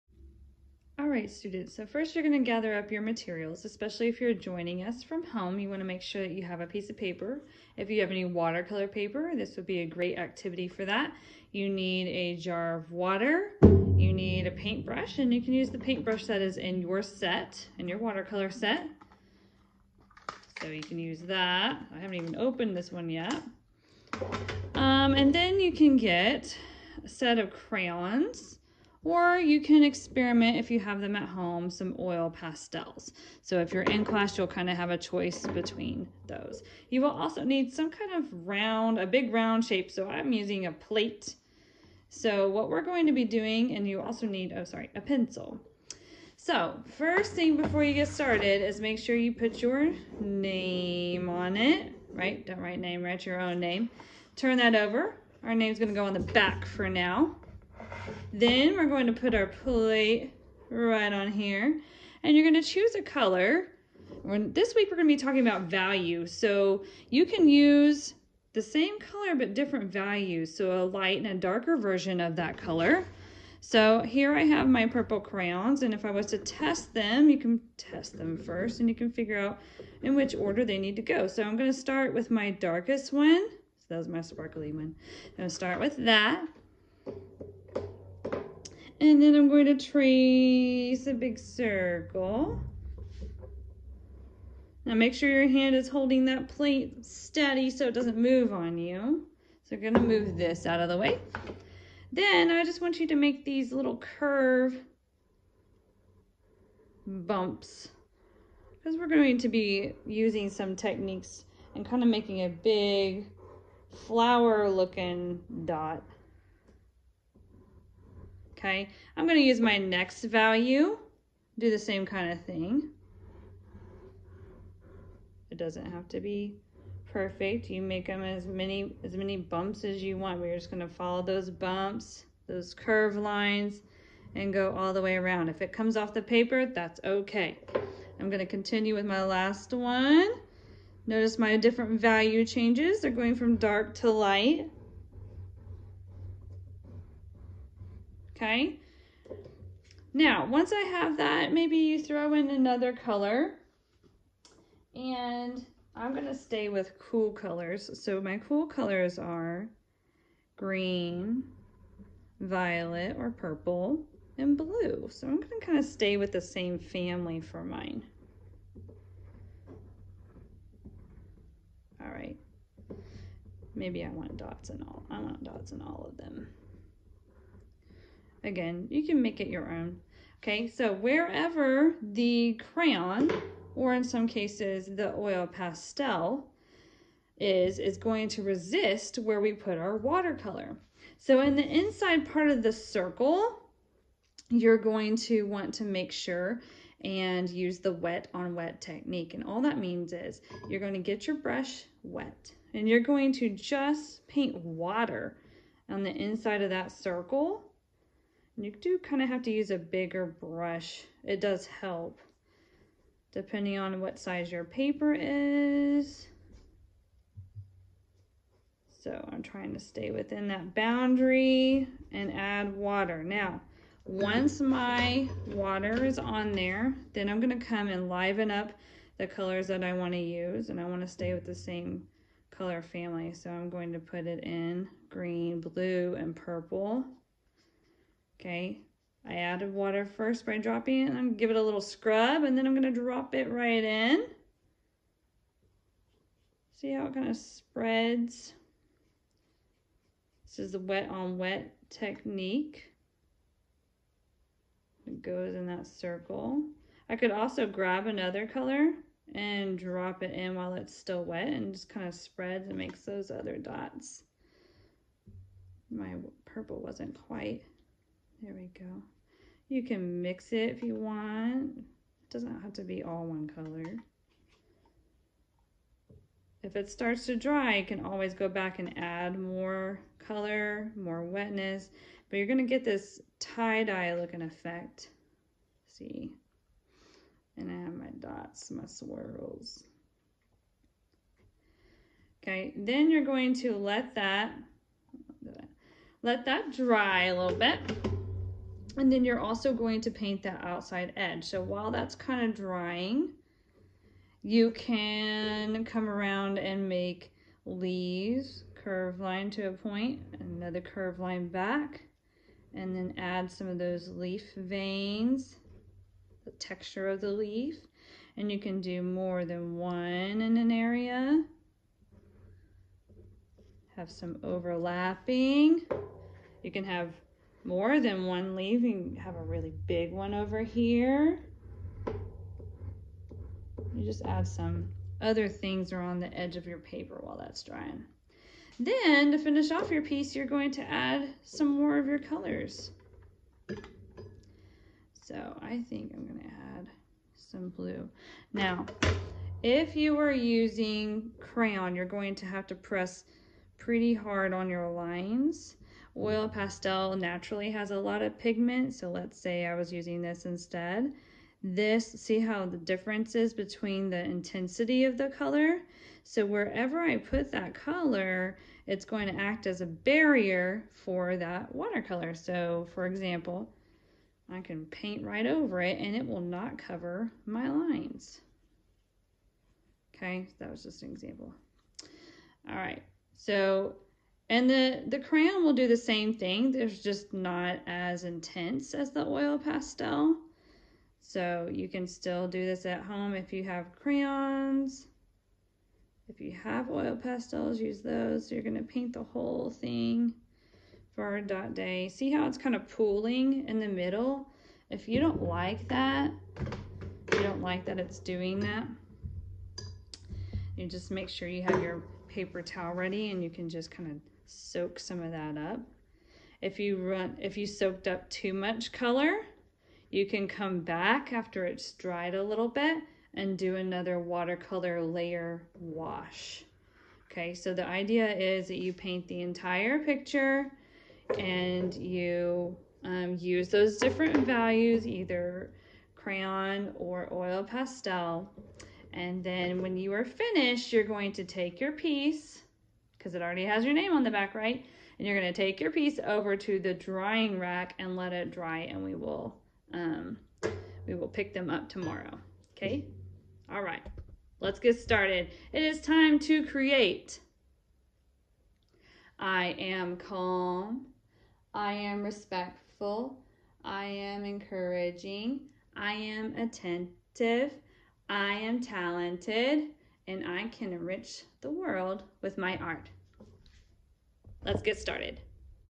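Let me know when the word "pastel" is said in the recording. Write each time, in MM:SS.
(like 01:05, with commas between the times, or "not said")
00:32, 03:05, 05:56, 06:29, 06:37, 07:17.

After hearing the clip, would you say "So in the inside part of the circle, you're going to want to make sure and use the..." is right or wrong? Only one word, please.
right.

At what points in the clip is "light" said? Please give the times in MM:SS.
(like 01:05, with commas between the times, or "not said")
01:10, 02:24.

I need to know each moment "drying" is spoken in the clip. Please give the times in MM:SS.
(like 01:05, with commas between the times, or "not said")
05:02, 05:37, 07:26.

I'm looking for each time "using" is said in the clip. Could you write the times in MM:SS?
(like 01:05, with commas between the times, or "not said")
00:40, 01:50, 05:50, 05:59.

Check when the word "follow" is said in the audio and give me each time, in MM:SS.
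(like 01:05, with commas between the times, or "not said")
02:10.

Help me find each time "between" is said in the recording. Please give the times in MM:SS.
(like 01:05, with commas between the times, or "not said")
00:35, 06:03.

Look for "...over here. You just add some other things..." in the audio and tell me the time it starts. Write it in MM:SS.
05:30.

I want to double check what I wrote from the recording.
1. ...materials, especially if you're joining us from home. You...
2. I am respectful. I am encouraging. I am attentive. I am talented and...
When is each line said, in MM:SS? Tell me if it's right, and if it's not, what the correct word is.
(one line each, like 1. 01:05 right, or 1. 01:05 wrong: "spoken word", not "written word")
1. 00:03 right
2. 07:41 right.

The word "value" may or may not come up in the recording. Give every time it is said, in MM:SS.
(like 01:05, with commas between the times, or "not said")
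01:05, 01:09, 02:00, 02:21, 07:14.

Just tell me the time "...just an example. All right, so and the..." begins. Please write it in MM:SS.
06:20.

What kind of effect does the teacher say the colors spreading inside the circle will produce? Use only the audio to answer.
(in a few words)
Tie-dye looking effect.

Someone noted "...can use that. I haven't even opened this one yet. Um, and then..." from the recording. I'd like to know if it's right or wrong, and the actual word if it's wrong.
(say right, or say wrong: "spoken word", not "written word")
right.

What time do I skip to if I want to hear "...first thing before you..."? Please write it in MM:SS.
00:46.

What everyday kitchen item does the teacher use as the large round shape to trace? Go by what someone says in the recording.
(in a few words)
A plate.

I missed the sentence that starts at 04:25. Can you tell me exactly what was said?
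My purple wasn't quite there we go.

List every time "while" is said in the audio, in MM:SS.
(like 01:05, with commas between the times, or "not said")
04:20, 05:01, 05:37.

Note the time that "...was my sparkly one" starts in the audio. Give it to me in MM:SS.
01:23.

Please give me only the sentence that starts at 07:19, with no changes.
And then when you are finished, you're going to take your piece because it already has your name on the back, right?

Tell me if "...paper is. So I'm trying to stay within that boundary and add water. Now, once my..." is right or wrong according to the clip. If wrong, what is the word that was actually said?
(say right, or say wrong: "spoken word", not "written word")
right.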